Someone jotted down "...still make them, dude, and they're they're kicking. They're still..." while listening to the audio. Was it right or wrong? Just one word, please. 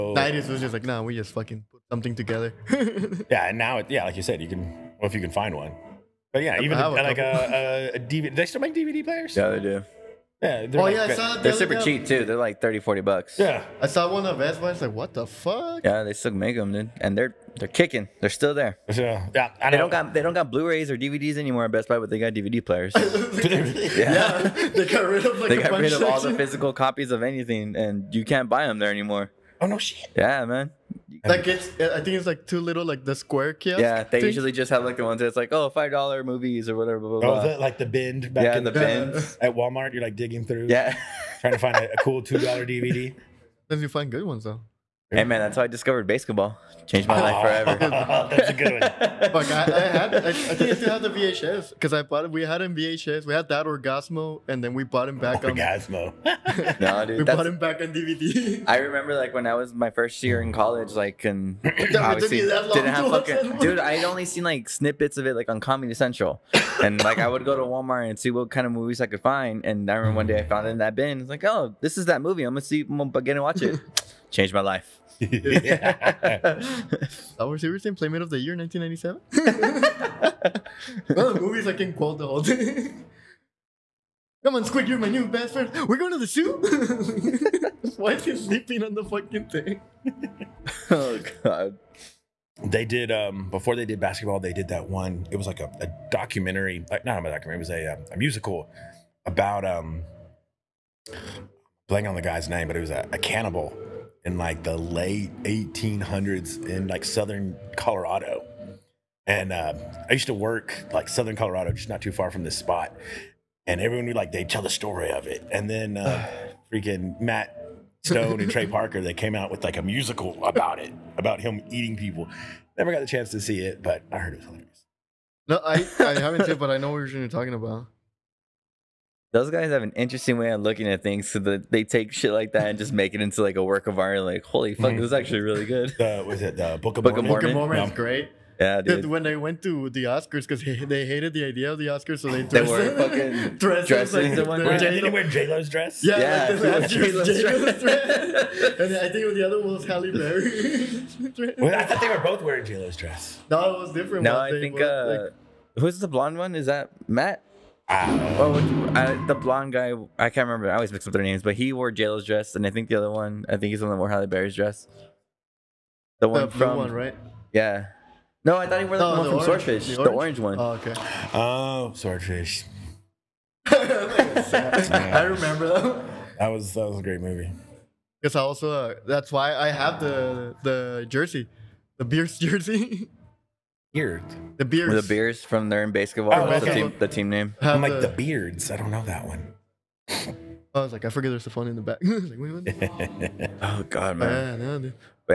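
right.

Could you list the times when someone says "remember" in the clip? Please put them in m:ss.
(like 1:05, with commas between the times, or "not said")
0:58, 1:09, 2:40, 2:55.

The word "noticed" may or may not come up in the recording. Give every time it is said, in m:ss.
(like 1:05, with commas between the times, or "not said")
not said.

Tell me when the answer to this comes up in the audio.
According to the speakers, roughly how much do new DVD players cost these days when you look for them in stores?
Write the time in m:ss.
0:12.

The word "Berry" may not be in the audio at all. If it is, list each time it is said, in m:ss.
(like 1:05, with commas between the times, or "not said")
2:30, 2:44.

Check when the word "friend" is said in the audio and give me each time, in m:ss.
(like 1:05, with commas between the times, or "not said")
1:25.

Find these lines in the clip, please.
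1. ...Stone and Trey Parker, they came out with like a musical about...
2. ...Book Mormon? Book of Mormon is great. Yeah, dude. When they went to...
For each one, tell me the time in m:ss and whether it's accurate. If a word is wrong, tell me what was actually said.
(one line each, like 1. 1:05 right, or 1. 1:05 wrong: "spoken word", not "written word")
1. 1:58 right
2. 2:17 right.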